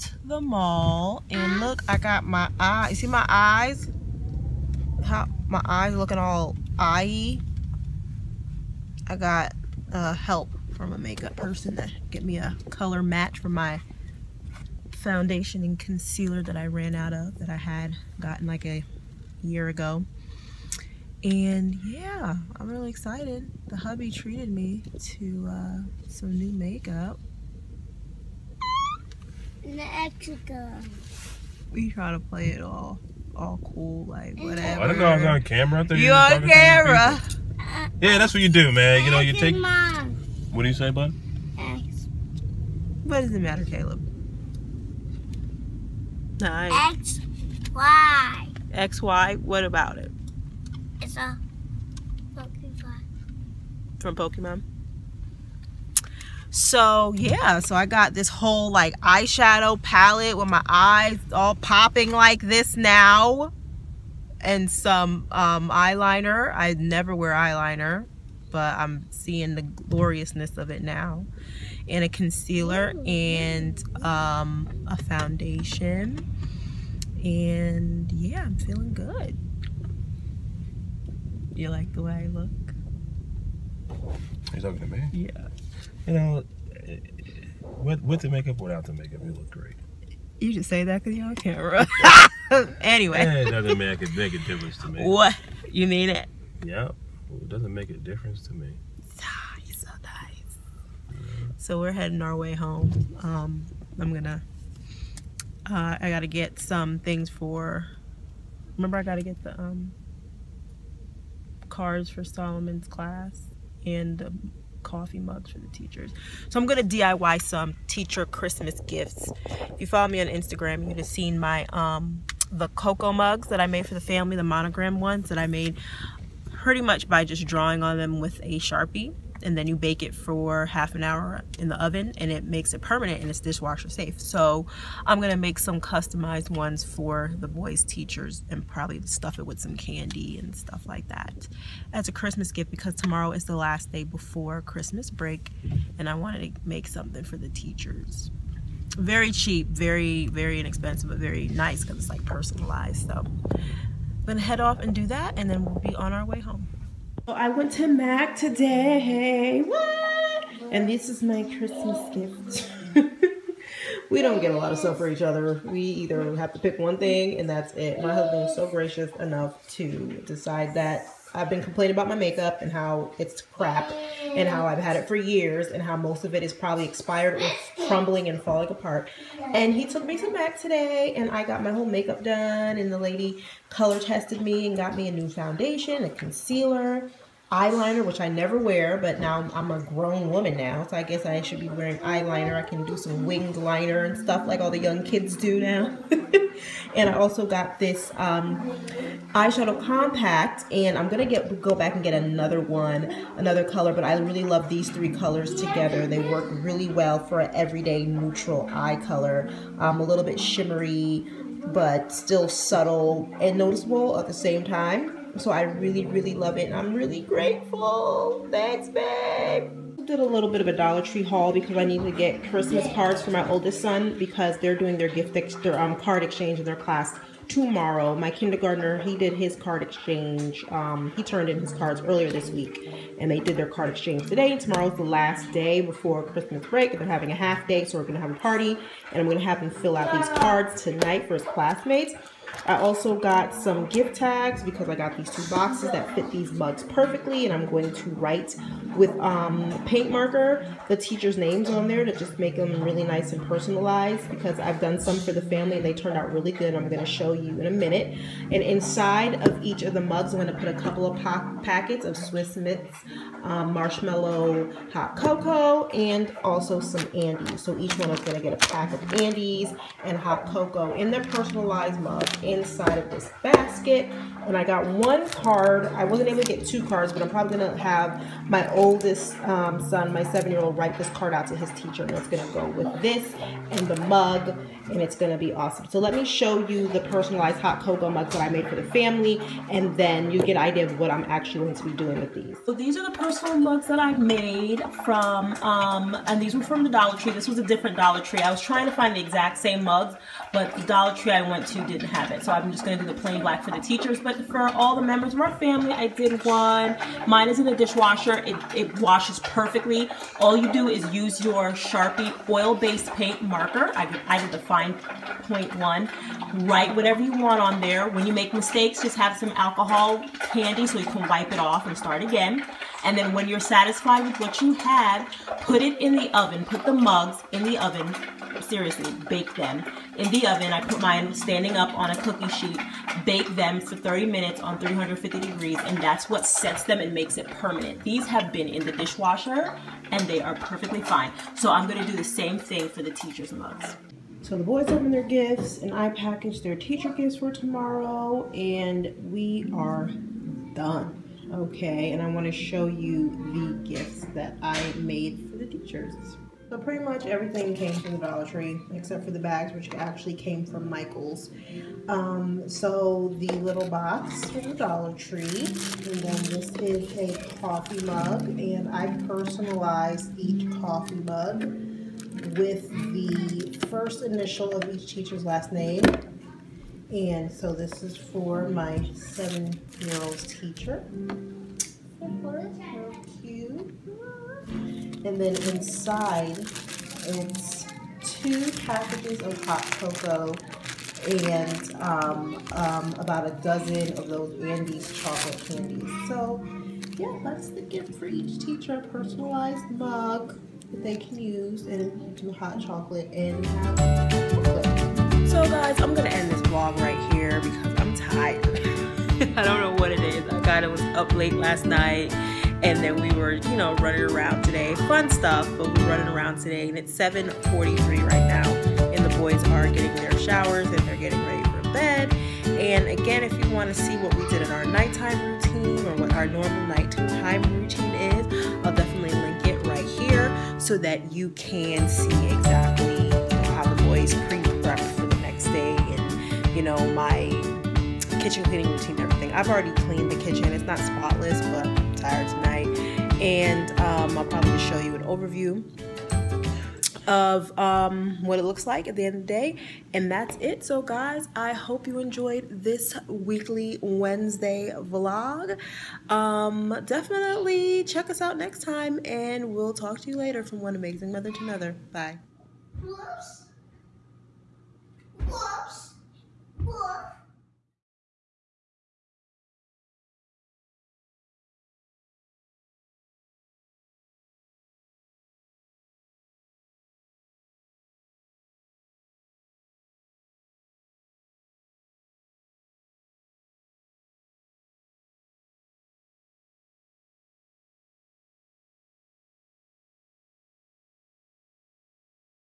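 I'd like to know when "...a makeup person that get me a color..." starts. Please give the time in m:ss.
0:10.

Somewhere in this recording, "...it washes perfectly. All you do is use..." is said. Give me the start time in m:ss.
5:08.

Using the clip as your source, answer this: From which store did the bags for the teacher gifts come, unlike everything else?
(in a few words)
Michael's.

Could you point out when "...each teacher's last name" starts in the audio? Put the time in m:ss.
6:14.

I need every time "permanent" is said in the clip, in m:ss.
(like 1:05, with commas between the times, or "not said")
2:12, 5:37.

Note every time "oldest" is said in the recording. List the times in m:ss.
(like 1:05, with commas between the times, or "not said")
3:43, 4:38.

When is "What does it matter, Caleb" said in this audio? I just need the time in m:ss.
0:43.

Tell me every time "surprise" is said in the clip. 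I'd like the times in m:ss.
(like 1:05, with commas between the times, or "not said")
not said.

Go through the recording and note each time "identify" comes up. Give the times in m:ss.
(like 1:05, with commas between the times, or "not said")
not said.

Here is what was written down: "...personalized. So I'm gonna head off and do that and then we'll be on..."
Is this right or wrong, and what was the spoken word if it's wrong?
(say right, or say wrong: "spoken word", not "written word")
right.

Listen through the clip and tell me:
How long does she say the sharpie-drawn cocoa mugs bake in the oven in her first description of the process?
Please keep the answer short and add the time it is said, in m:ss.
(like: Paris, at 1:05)
Half an hour, at 2:10.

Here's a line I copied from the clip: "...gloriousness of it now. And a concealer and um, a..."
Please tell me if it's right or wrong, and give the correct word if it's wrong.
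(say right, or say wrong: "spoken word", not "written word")
right.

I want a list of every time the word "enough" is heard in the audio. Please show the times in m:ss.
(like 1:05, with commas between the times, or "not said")
2:49.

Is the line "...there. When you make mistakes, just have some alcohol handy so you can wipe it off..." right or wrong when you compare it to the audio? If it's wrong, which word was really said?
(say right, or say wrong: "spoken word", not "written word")
right.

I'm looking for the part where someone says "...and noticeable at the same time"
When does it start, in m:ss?
3:33.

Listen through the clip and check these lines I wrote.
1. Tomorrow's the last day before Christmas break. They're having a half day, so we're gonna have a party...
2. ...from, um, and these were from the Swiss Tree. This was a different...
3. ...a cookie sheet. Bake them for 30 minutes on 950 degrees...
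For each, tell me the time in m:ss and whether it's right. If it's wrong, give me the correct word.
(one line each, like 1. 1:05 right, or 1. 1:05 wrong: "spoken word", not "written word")
1. 3:54 right
2. 4:55 wrong: "Dollar", not "Swiss"
3. 5:32 wrong: "350", not "950".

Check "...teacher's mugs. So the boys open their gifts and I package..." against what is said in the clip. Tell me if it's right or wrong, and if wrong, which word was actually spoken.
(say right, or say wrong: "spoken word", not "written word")
right.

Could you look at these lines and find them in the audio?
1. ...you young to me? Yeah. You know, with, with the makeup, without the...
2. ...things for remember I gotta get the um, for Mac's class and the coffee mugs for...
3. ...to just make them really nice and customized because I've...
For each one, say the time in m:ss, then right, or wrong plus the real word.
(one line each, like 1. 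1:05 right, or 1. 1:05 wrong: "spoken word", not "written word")
1. 1:24 wrong: "talking", not "young"
2. 1:46 wrong: "Solomon", not "Mac"
3. 4:12 wrong: "personalized", not "customized".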